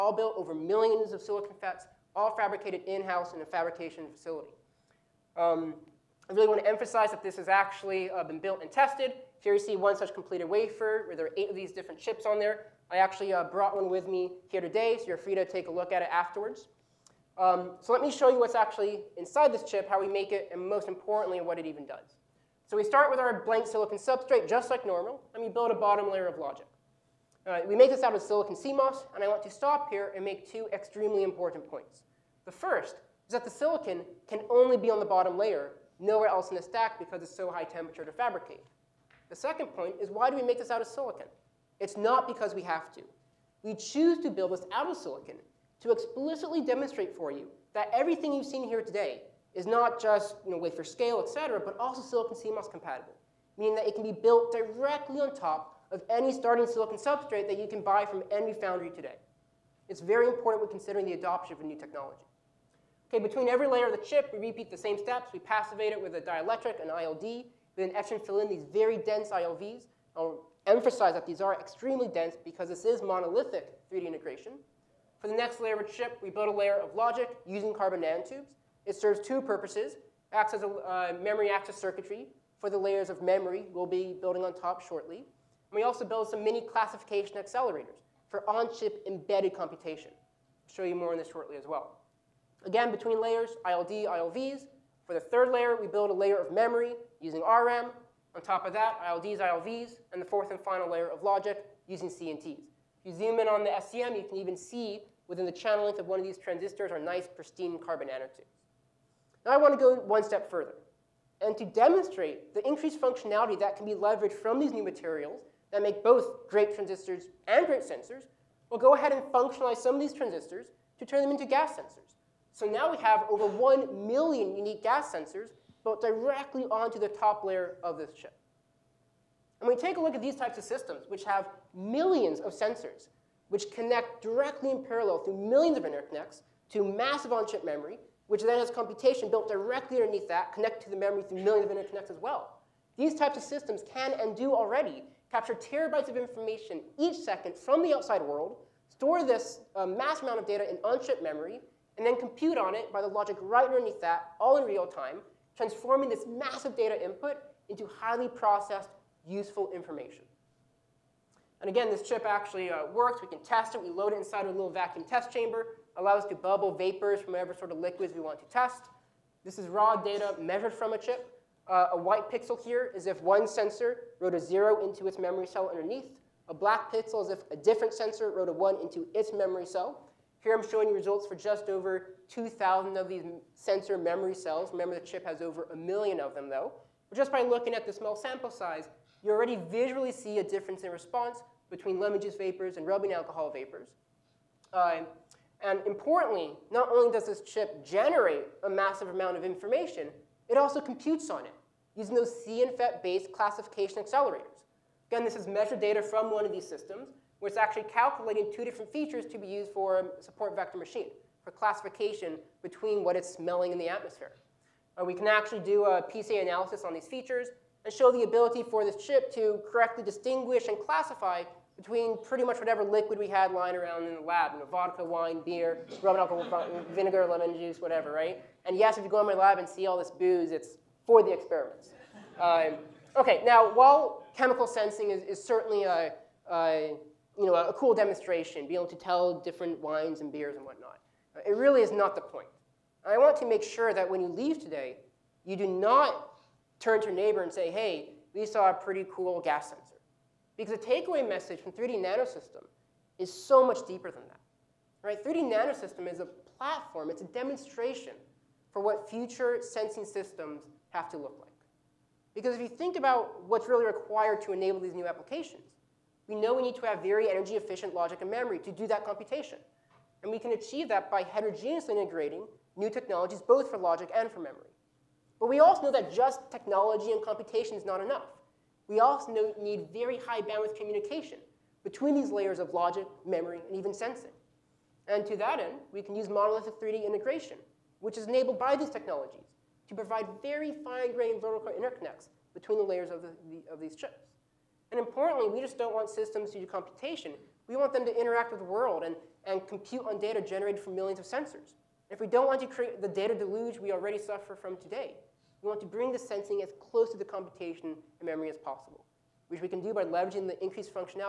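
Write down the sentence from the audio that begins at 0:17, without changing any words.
Um, so let me show you what's actually inside this chip, how we make it, and most importantly, what it even does.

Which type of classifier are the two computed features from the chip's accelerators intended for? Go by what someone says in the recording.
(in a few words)
support vector machine.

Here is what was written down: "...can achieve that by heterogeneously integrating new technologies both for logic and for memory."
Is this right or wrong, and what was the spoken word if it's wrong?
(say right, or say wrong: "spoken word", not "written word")
right.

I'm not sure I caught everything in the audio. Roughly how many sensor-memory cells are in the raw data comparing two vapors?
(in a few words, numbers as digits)
just over 2,000.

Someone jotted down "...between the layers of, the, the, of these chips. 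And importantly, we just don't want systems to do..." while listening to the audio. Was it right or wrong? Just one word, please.
right.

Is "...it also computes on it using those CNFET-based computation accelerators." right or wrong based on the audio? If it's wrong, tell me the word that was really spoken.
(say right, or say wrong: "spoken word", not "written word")
wrong: "classification", not "computation".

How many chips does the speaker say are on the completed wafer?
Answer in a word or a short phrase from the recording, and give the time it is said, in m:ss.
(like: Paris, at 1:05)
8, at 0:11.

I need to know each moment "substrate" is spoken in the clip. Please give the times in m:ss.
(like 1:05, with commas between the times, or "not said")
0:23, 0:56.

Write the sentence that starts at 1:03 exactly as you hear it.
Okay, between every layer of the chip, we repeat the same steps.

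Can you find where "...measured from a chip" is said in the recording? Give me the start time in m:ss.
2:50.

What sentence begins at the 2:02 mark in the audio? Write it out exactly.
So now we have over 1 million unique gas sensors built directly onto the top layer of this chip.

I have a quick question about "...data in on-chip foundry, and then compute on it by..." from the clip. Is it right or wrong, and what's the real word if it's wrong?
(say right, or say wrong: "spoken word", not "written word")
wrong: "memory", not "foundry".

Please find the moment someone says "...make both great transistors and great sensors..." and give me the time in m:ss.
1:55.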